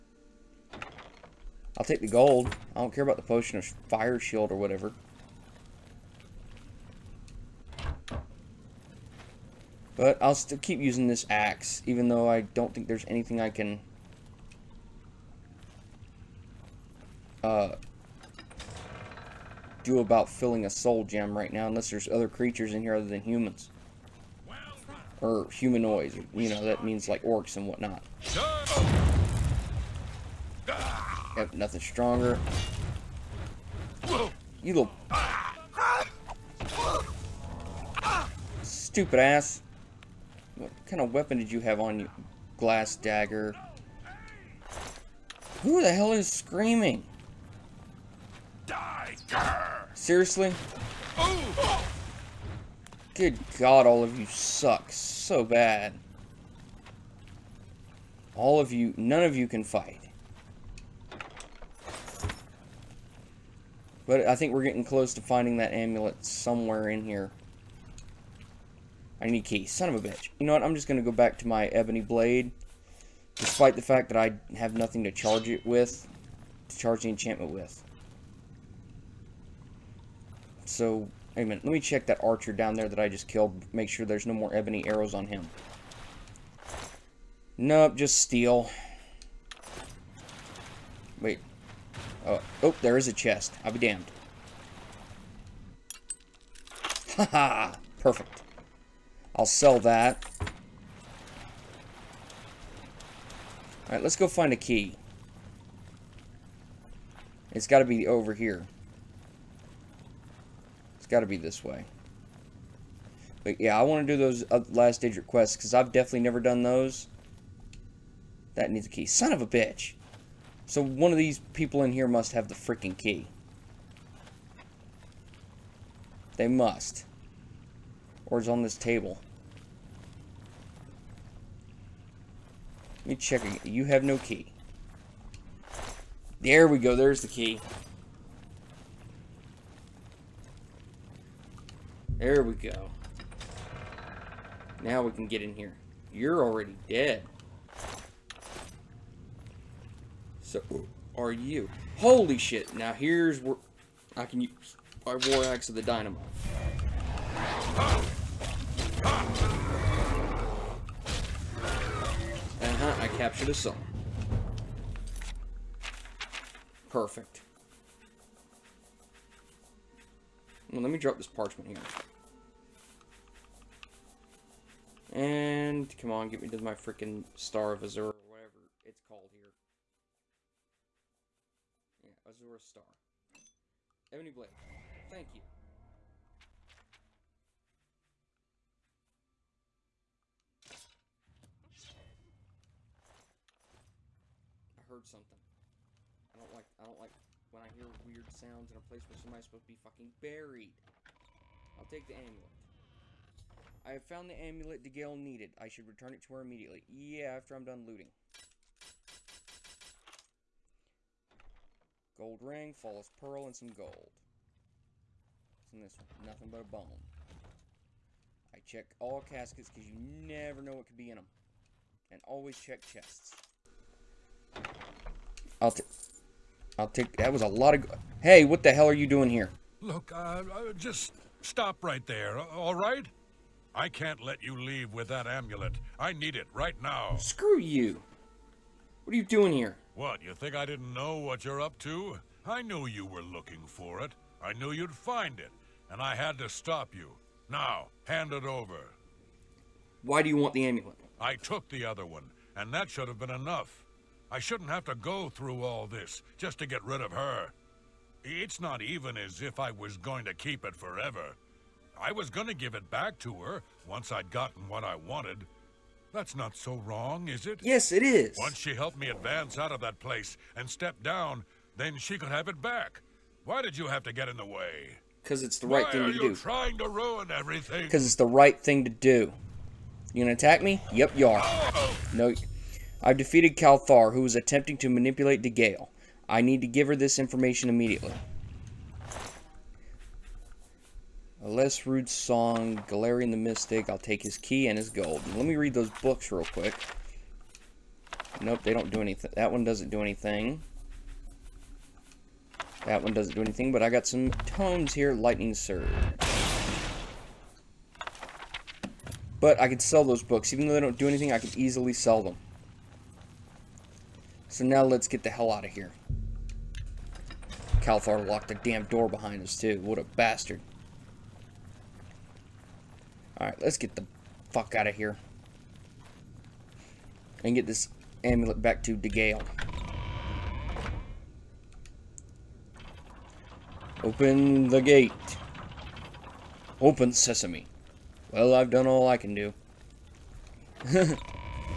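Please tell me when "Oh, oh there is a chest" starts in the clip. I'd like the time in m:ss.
1:32.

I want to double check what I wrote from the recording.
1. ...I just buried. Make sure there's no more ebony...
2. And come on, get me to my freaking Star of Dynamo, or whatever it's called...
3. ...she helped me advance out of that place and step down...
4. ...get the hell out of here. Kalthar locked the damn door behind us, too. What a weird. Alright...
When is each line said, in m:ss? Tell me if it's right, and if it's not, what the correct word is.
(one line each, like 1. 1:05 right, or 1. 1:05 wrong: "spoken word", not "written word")
1. 1:22 wrong: "killed", not "buried"
2. 2:55 wrong: "Azura", not "Dynamo"
3. 4:28 right
4. 5:15 wrong: "bastard", not "weird".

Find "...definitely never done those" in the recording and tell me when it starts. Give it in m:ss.
1:55.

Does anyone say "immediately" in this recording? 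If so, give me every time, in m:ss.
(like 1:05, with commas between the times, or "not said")
3:26, 4:47.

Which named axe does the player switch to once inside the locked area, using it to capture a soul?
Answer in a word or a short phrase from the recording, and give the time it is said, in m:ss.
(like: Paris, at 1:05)
War Axe of the Dynamo, at 2:35.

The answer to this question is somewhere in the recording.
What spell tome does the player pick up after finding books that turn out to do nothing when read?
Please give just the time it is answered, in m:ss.
5:05.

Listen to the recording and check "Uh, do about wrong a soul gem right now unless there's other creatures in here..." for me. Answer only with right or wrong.
wrong.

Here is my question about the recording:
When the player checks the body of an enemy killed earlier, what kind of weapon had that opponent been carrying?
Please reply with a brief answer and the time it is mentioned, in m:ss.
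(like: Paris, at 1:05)
Glass dagger, at 0:42.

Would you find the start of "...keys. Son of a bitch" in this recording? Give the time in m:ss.
1:09.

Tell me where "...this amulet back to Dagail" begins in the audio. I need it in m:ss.
5:27.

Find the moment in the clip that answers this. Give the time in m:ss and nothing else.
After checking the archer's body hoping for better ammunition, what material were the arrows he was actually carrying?
1:27.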